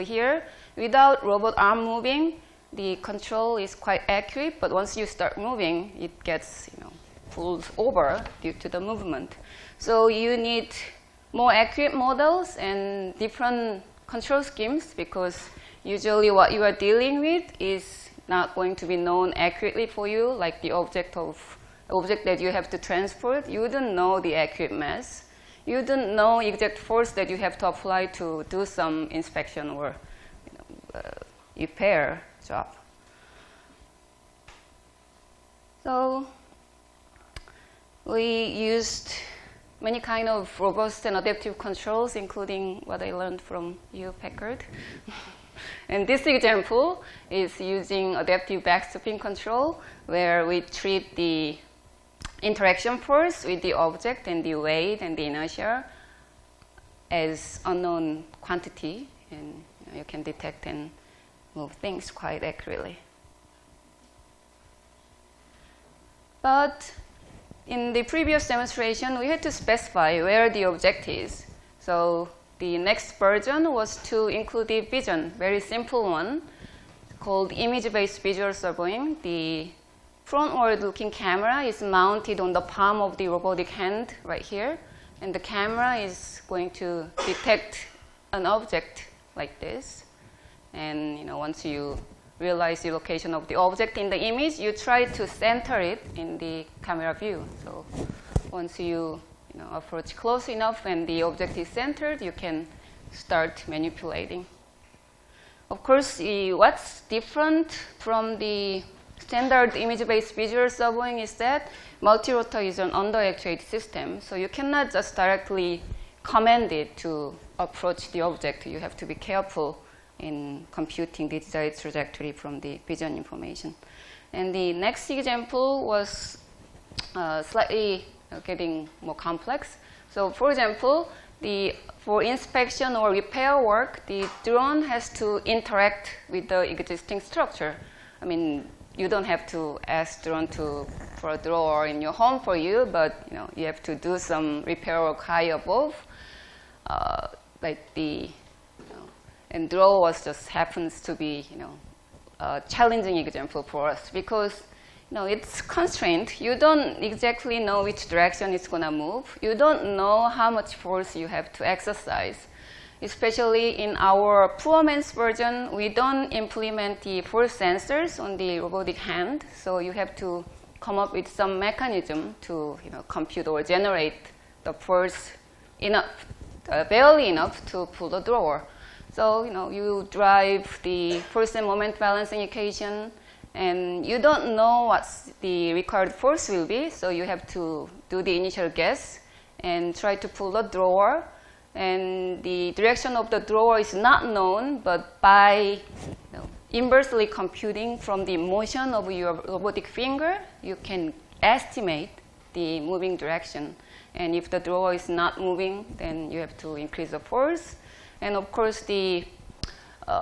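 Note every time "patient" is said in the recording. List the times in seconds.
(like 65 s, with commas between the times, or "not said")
not said.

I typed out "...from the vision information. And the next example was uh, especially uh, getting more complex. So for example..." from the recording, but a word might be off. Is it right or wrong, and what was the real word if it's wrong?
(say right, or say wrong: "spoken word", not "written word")
wrong: "slightly", not "especially".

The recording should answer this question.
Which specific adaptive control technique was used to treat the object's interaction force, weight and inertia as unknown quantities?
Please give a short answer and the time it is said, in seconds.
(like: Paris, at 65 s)
Adaptive backstepping control, at 48 s.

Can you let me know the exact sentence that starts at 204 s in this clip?
And if the drawer is not moving, then you have to increase the force.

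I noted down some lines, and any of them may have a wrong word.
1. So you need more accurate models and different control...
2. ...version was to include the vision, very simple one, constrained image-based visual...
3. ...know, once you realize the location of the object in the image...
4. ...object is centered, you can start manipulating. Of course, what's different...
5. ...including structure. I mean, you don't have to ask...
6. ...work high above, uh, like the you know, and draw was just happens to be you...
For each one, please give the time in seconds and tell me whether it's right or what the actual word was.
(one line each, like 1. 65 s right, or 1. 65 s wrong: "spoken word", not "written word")
1. 9 s right
2. 73 s wrong: "called", not "constrained"
3. 91 s right
4. 101 s right
5. 136 s wrong: "existing", not "including"
6. 145 s right.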